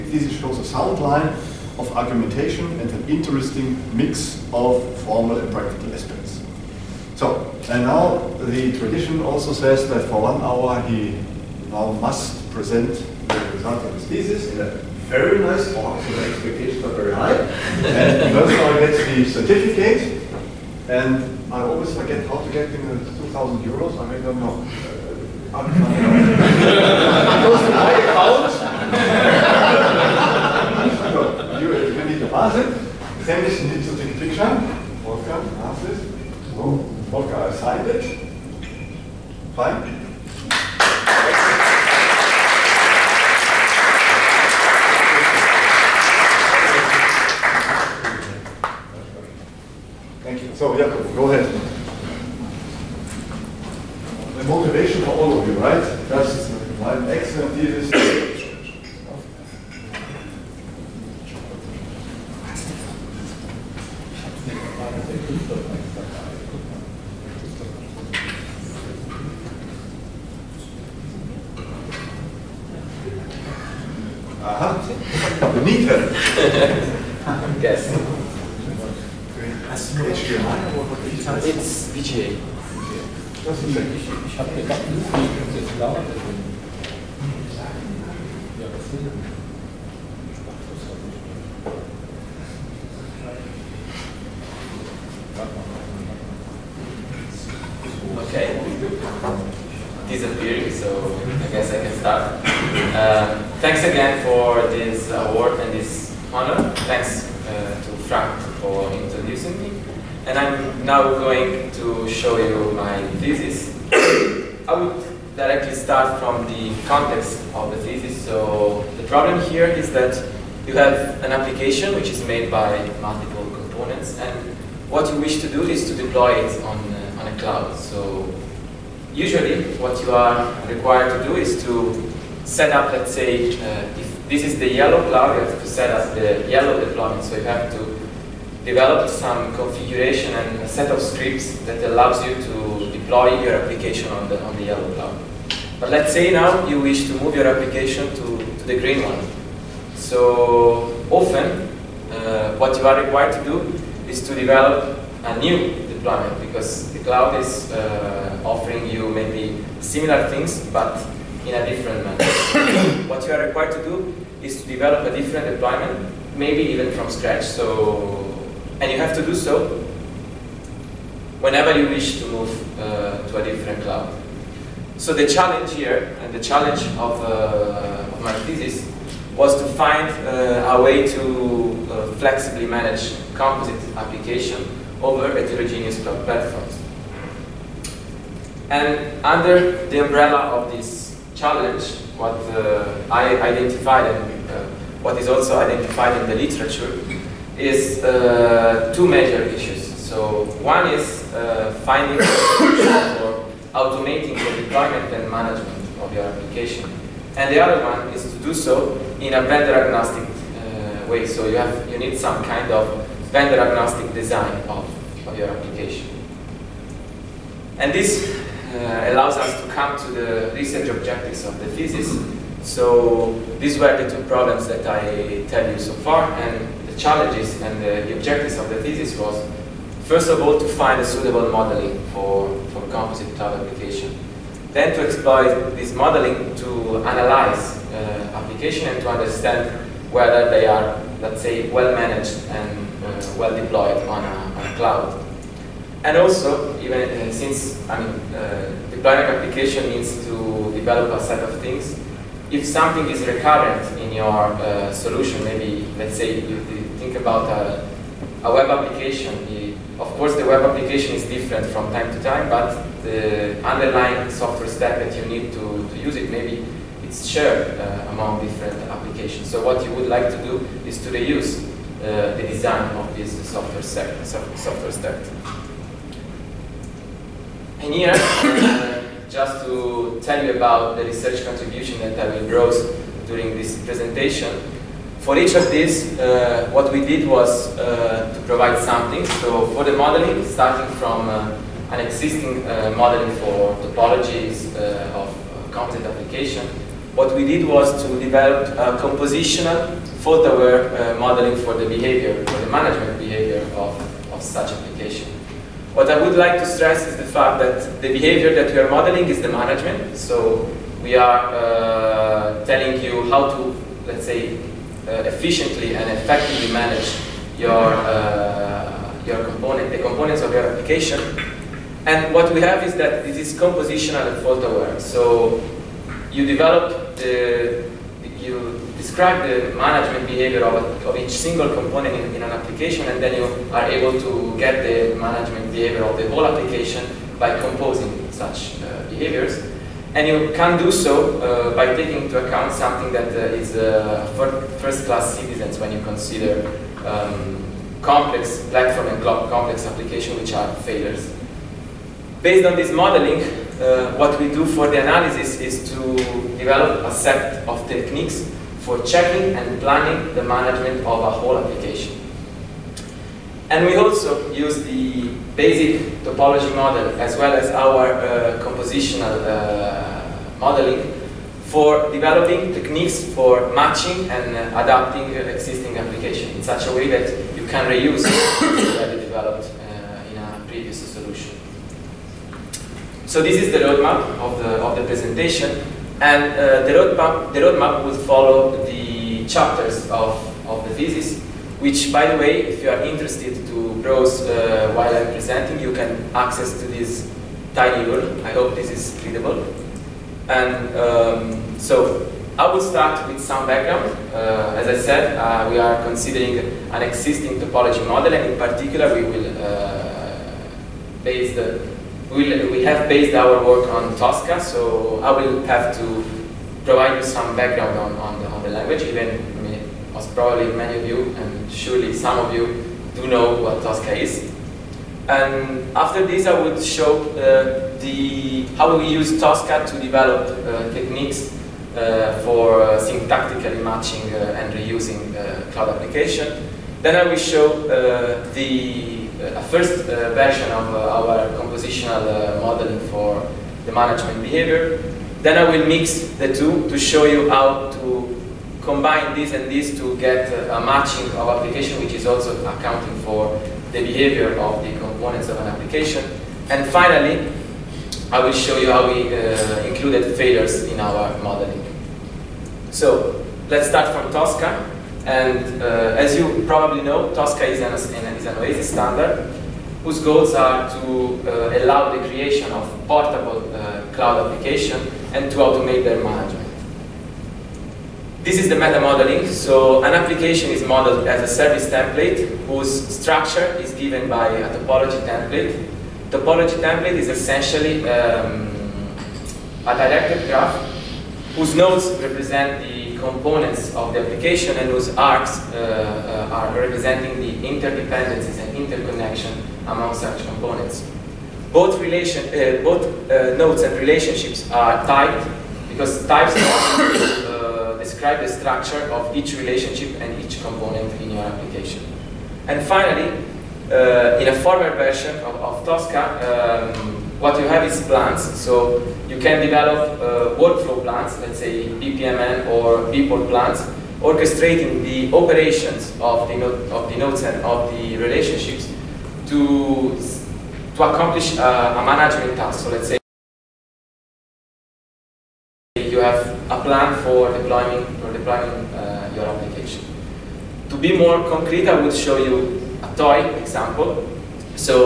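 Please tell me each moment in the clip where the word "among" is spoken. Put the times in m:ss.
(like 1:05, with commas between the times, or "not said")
4:28, 8:19.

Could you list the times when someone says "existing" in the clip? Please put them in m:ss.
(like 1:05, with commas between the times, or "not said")
4:52, 6:15, 6:47.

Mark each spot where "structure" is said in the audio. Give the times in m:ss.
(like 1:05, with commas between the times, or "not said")
8:03, 8:28.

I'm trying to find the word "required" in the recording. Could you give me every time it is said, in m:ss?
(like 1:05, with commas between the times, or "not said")
2:10, 2:33, 2:43.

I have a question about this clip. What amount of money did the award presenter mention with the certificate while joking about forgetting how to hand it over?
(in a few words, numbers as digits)
2,000 euros.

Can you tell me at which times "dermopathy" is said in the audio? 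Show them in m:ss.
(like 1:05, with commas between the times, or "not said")
not said.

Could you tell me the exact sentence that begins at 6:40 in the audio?
And um, so I will start with some background.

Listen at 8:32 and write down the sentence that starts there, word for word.
And finally, uh, in a former version of, of Tosca, um, what you have is plans.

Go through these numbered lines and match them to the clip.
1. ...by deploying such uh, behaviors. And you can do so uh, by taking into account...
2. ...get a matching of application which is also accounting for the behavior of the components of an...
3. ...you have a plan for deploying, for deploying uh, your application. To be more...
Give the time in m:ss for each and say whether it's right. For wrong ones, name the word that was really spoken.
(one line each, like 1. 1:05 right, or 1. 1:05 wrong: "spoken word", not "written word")
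1. 5:37 wrong: "composing", not "deploying"
2. 7:30 right
3. 8:56 right.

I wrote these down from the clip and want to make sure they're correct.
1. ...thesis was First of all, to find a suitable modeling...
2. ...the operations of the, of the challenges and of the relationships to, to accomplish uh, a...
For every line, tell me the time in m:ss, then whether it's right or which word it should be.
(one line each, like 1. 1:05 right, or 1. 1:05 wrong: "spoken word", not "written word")
1. 3:48 right
2. 8:45 wrong: "nodes", not "challenges".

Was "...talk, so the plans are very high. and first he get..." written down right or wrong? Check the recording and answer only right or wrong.
wrong.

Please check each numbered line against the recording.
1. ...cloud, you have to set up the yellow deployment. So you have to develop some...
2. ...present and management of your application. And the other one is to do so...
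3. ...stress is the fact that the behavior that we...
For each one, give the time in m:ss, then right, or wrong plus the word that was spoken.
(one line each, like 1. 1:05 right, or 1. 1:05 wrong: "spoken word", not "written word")
1. 2:15 right
2. 3:24 wrong: "deployment", not "present"
3. 5:06 right.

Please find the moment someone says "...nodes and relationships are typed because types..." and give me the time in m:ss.
8:23.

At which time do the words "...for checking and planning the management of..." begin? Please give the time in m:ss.
5:58.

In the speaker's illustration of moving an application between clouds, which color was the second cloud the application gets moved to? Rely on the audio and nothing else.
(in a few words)
green.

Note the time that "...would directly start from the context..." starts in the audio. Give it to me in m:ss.
1:54.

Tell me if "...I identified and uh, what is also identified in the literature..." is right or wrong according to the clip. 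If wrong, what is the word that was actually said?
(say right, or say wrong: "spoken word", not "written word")
right.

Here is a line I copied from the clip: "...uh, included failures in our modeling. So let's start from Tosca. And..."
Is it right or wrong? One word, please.
right.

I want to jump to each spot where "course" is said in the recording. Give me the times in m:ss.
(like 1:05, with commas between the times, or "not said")
4:20.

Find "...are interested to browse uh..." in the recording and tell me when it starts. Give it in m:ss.
6:32.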